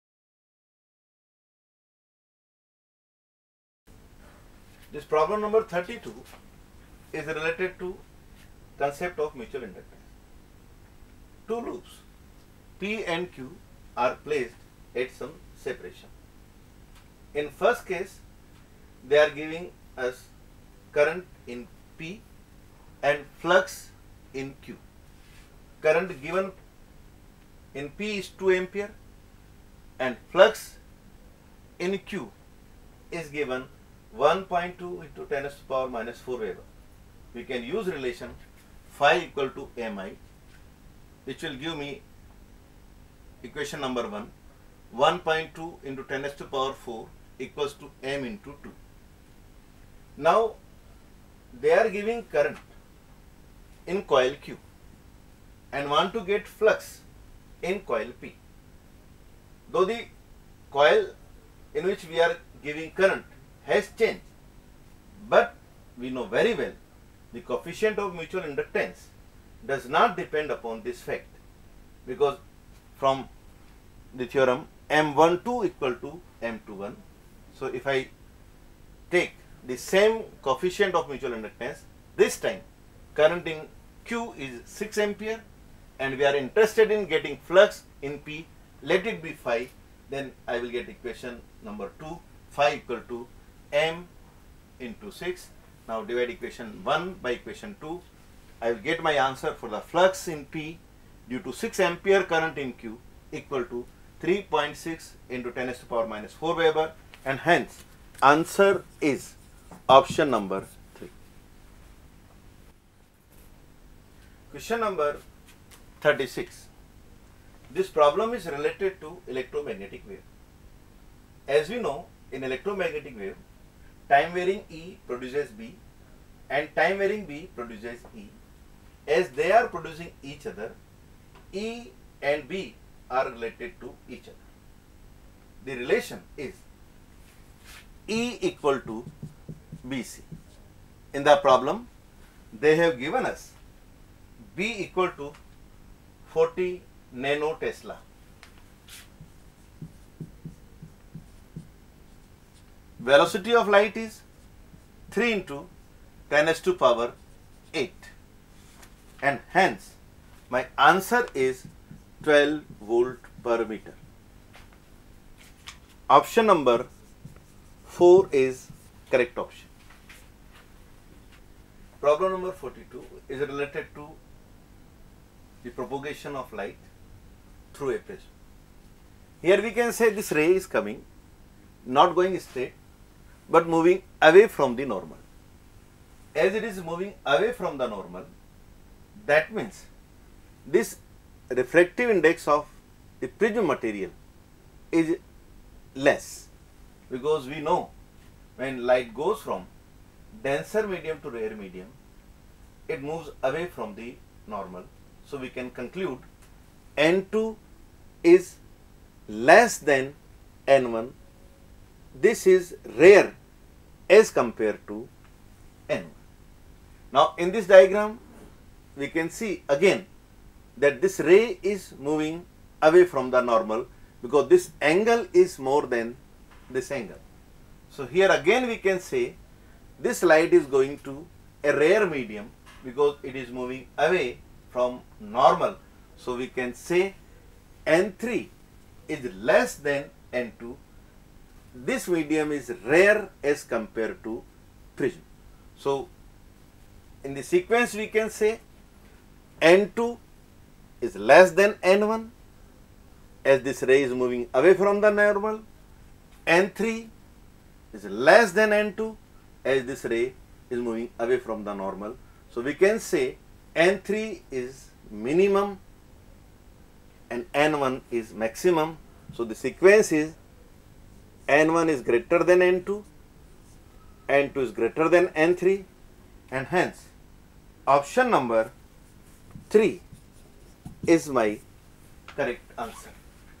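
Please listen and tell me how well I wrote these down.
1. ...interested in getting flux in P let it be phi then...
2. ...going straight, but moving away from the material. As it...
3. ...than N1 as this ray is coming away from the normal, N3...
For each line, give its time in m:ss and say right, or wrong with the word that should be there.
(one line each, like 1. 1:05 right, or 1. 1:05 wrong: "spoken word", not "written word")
1. 1:26 right
2. 3:02 wrong: "normal", not "material"
3. 4:11 wrong: "moving", not "coming".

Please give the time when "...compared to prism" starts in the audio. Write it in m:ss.
4:03.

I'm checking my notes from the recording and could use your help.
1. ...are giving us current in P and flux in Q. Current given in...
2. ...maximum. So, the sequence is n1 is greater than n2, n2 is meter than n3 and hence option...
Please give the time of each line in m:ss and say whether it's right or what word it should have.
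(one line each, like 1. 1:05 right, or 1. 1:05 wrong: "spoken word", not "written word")
1. 0:19 right
2. 4:28 wrong: "greater", not "meter".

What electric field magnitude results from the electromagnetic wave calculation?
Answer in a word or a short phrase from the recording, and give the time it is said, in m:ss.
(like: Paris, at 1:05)
12 volt per meter, at 2:42.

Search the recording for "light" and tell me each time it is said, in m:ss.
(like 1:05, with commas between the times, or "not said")
2:33, 2:56, 3:18, 3:50.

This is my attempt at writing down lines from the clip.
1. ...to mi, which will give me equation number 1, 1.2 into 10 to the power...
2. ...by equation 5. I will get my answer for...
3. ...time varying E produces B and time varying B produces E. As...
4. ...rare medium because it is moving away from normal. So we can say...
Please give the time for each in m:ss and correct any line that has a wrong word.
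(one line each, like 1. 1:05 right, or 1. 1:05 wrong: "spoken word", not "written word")
1. 0:39 right
2. 1:37 wrong: "2", not "5"
3. 2:04 right
4. 3:51 right.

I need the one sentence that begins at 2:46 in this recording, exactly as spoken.
Option number 4 is correct option.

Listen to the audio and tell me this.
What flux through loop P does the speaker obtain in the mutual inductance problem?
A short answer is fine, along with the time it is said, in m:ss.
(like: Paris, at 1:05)
3.6 × 10^-4 Weber, at 1:44.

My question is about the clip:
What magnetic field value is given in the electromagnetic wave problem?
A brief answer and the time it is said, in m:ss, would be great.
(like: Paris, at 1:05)
40 nanotesla, at 2:26.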